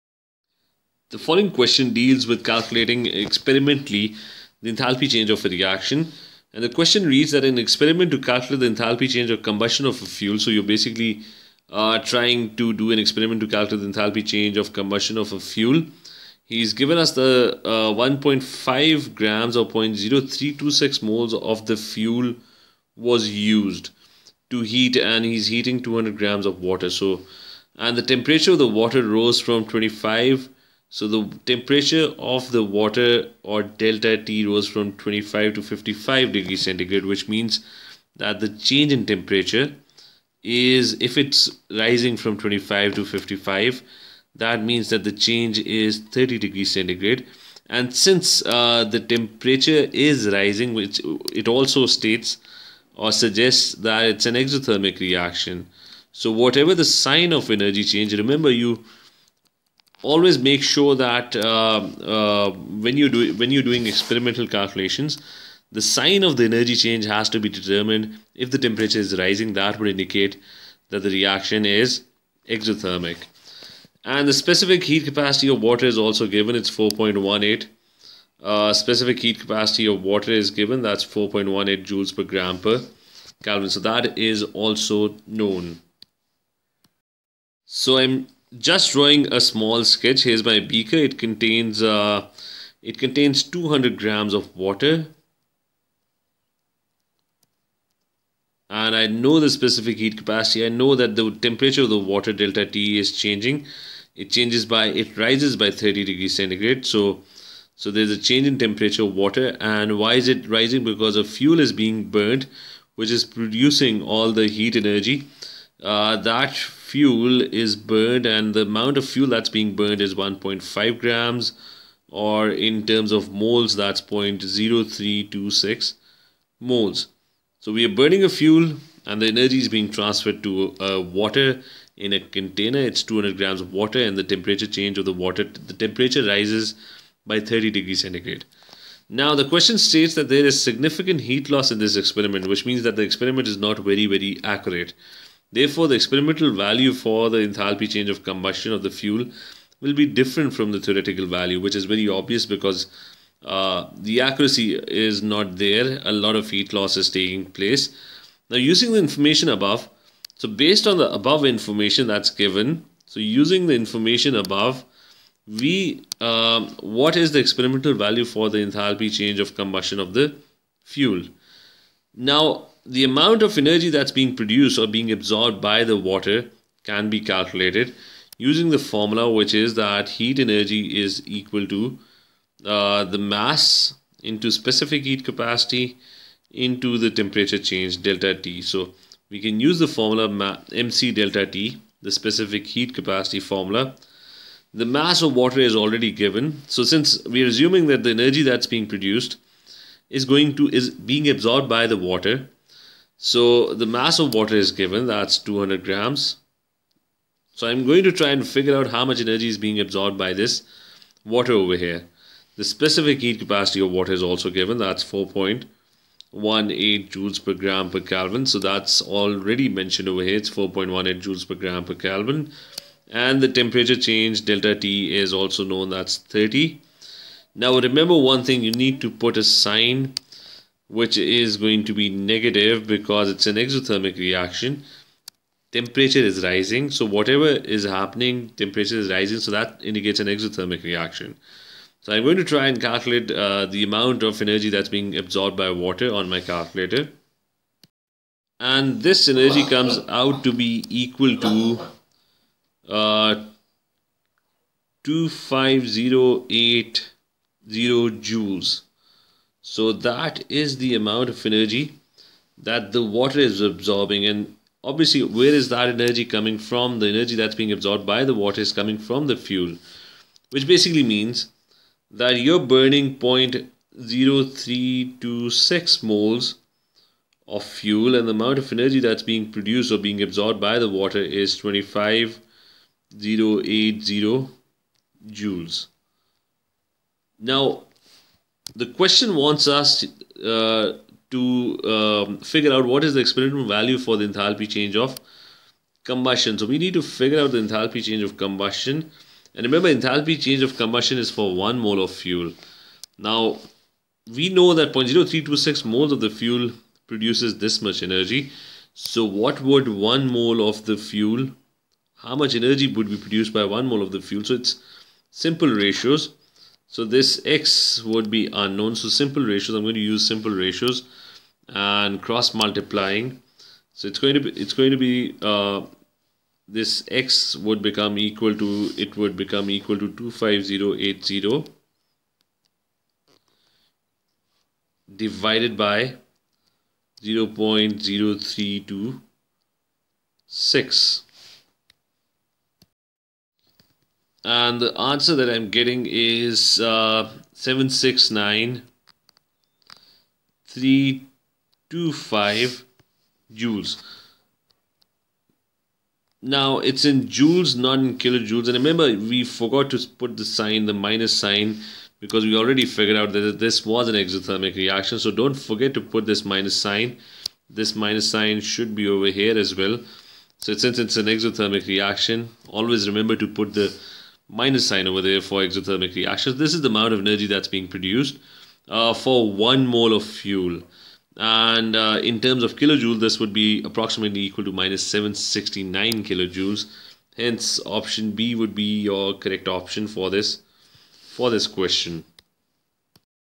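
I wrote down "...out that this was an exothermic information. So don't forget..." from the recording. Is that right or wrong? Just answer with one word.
wrong.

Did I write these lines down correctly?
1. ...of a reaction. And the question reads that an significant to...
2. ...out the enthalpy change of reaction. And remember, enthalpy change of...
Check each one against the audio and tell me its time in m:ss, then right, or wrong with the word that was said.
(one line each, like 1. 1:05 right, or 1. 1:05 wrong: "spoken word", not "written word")
1. 0:05 wrong: "experiment", not "significant"
2. 4:57 wrong: "combustion", not "reaction".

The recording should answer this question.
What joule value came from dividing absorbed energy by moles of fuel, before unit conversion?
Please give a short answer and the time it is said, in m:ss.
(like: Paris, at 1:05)
769325 joules, at 5:47.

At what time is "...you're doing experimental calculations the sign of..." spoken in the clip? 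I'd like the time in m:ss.
1:03.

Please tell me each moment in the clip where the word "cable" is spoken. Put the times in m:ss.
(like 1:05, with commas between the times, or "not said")
not said.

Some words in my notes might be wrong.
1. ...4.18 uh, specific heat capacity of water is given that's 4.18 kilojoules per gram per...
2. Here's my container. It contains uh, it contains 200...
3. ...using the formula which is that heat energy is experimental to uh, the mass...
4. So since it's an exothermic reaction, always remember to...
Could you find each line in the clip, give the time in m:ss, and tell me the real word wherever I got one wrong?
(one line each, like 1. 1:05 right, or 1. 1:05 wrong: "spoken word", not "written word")
1. 1:16 wrong: "joules", not "kilojoules"
2. 1:30 wrong: "beaker", not "container"
3. 2:58 wrong: "equal", not "experimental"
4. 6:10 right.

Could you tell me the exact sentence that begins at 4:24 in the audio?
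And obviously, where is that energy coming from?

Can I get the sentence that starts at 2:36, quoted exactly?
A lot of heat loss is taking place.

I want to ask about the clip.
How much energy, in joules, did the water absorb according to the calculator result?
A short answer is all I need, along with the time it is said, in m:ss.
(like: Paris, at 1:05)
25080 joules, at 4:15.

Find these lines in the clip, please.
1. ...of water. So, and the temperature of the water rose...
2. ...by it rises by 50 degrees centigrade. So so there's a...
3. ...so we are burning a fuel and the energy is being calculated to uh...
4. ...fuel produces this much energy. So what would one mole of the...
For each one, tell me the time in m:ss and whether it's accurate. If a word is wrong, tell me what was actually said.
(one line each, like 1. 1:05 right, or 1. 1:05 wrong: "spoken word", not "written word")
1. 0:26 right
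2. 1:44 wrong: "30", not "50"
3. 2:07 wrong: "transferred", not "calculated"
4. 5:06 right.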